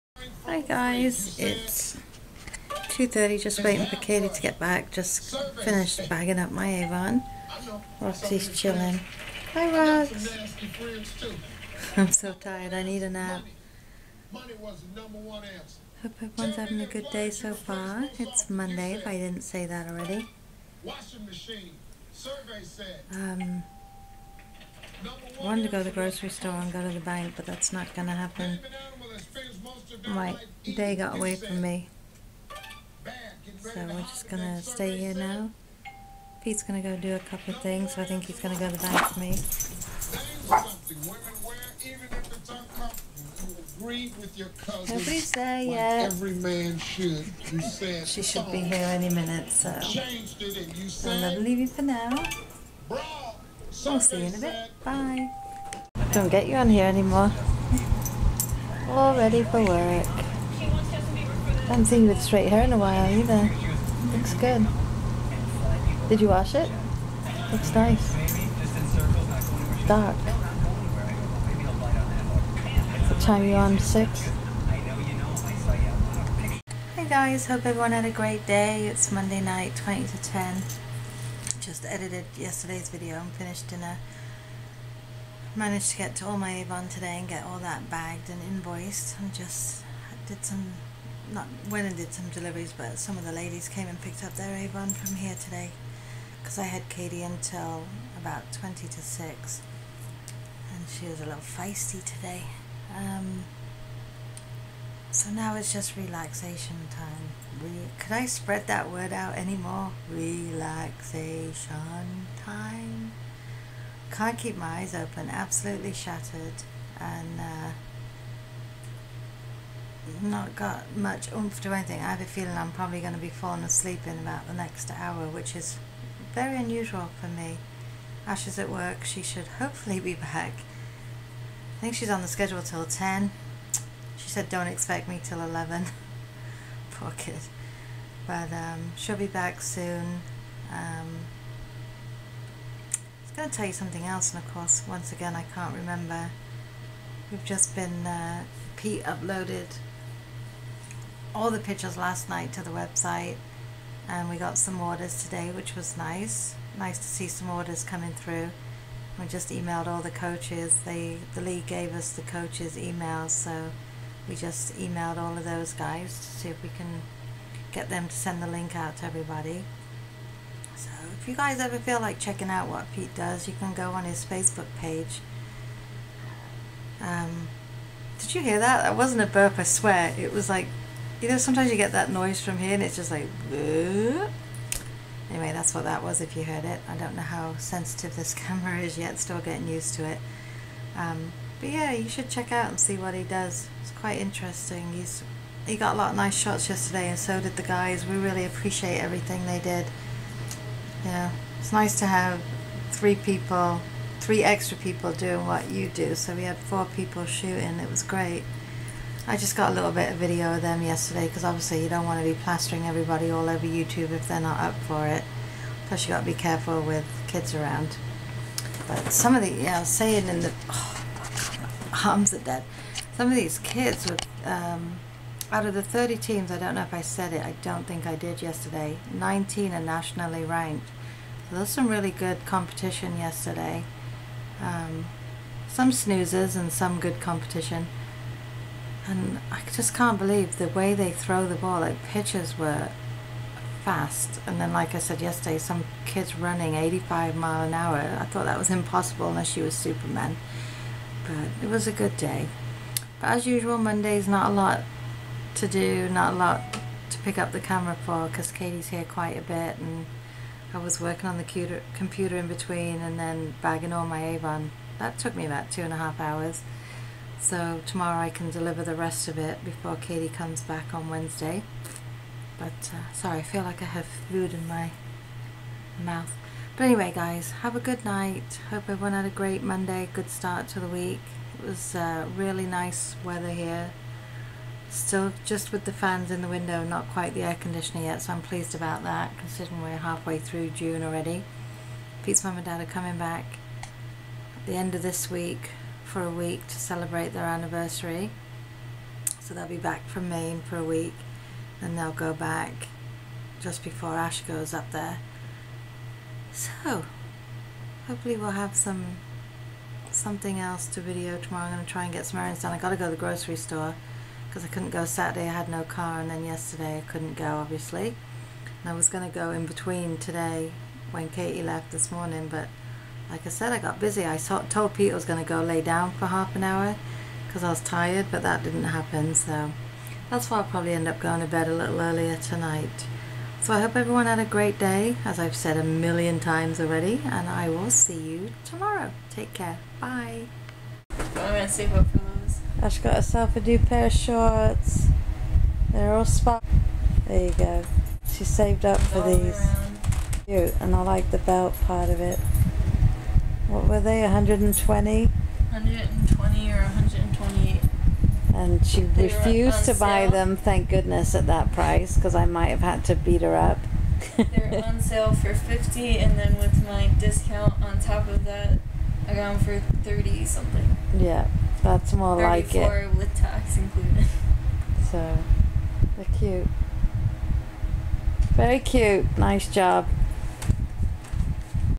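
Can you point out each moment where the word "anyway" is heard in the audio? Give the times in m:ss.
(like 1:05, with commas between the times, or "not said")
3:05, 4:36.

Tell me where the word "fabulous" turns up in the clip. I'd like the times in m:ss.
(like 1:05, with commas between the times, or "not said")
not said.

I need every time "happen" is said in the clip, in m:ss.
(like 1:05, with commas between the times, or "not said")
0:28, 5:28.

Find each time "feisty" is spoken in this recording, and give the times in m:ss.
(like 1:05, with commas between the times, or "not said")
1:41.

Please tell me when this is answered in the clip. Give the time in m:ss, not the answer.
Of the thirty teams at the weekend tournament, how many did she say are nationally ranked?
3:49.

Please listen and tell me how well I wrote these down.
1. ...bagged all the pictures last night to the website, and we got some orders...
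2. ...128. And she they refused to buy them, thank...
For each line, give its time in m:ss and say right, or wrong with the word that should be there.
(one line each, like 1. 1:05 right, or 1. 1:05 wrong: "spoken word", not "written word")
1. 2:29 wrong: "uploaded", not "bagged"
2. 5:56 right.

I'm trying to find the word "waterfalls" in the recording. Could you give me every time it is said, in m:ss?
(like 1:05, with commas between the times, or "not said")
not said.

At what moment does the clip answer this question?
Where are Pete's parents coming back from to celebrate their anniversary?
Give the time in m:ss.
5:00.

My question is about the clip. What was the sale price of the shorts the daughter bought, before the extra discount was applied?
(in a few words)
50.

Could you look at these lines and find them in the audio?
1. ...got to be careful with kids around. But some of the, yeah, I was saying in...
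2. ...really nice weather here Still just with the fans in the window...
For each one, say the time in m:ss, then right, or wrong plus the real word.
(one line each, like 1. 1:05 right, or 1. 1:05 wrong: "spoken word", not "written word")
1. 3:36 right
2. 4:42 right.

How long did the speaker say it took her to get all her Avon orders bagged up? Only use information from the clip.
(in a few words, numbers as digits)
2 and a half hours.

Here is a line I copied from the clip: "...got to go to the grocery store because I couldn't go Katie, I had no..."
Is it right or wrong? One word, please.
wrong.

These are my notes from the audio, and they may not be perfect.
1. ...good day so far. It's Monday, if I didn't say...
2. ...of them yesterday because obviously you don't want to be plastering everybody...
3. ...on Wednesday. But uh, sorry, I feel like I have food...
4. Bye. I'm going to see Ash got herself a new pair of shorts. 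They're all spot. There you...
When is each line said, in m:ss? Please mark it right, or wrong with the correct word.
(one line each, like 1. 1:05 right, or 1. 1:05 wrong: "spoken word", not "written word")
1. 0:16 right
2. 3:30 right
3. 4:30 right
4. 5:40 right.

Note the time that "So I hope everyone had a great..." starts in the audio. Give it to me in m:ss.
5:33.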